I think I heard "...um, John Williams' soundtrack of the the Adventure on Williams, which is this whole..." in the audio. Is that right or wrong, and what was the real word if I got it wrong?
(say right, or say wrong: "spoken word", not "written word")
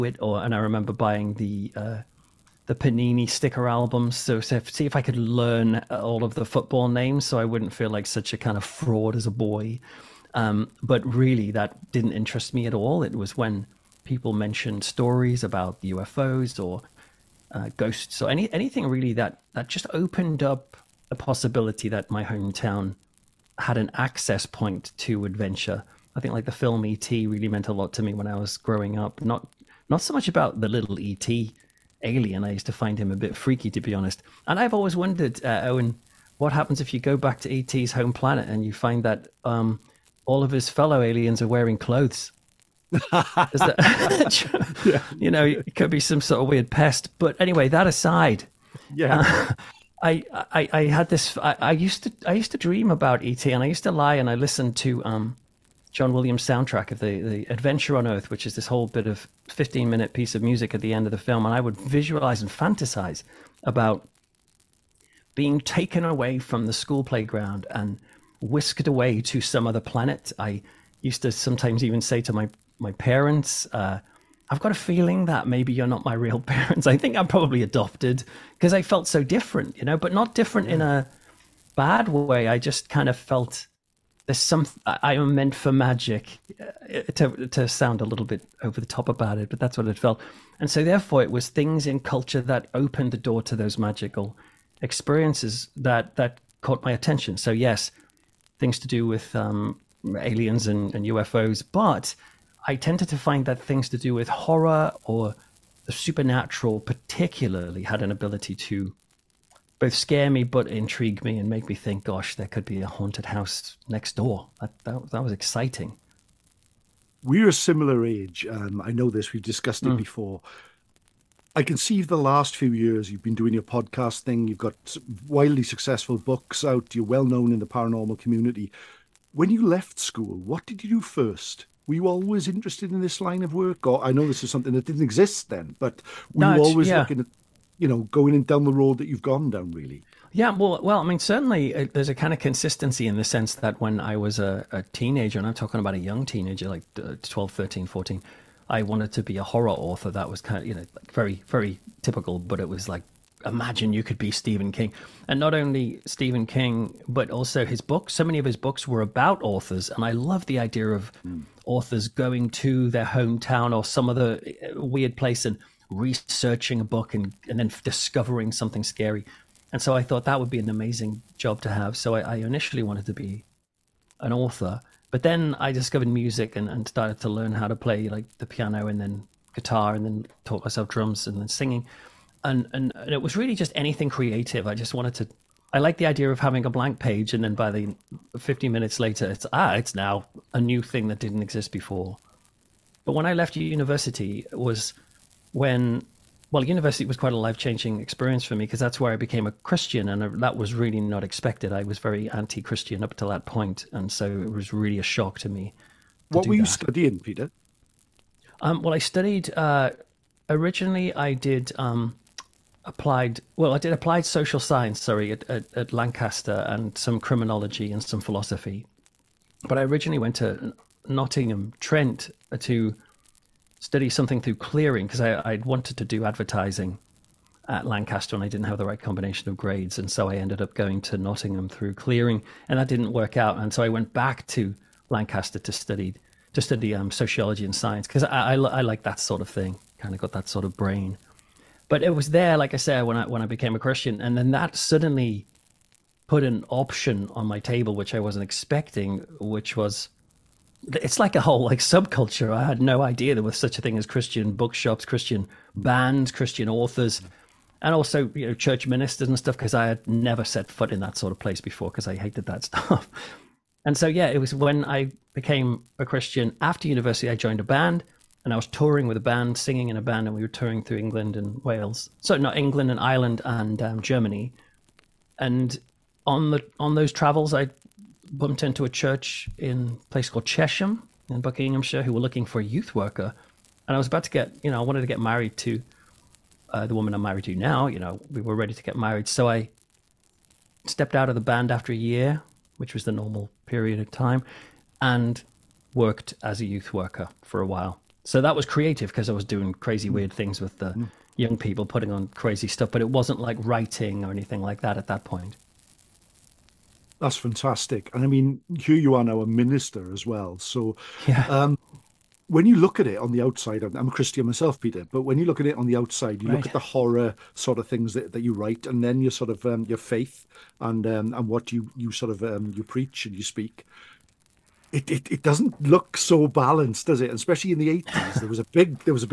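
wrong: "Earth", not "Williams".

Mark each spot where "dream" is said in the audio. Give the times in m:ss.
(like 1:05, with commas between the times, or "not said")
0:52.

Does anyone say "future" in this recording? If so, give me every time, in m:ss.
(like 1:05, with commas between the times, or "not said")
not said.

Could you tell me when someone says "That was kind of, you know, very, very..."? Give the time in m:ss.
2:30.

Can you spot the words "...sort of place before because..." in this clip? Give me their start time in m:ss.
4:21.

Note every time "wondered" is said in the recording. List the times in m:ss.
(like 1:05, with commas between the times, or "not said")
0:34.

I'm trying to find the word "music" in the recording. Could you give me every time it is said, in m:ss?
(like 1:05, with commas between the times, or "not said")
1:00, 2:56.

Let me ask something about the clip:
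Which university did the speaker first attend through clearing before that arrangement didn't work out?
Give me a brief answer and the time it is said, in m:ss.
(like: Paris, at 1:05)
Nottingham Trent, at 3:41.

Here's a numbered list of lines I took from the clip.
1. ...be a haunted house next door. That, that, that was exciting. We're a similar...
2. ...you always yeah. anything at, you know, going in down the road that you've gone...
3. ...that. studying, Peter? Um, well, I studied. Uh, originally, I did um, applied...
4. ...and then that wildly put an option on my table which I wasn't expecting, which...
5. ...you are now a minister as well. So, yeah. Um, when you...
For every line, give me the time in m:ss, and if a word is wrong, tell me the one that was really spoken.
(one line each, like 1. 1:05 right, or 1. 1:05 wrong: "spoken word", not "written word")
1. 1:52 right
2. 2:16 wrong: "looking", not "anything"
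3. 3:26 right
4. 4:04 wrong: "suddenly", not "wildly"
5. 5:08 right.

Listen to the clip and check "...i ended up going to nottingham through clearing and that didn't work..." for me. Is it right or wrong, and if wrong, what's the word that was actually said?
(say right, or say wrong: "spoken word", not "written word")
right.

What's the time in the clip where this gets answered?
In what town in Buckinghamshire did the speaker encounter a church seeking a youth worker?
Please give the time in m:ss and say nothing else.
4:40.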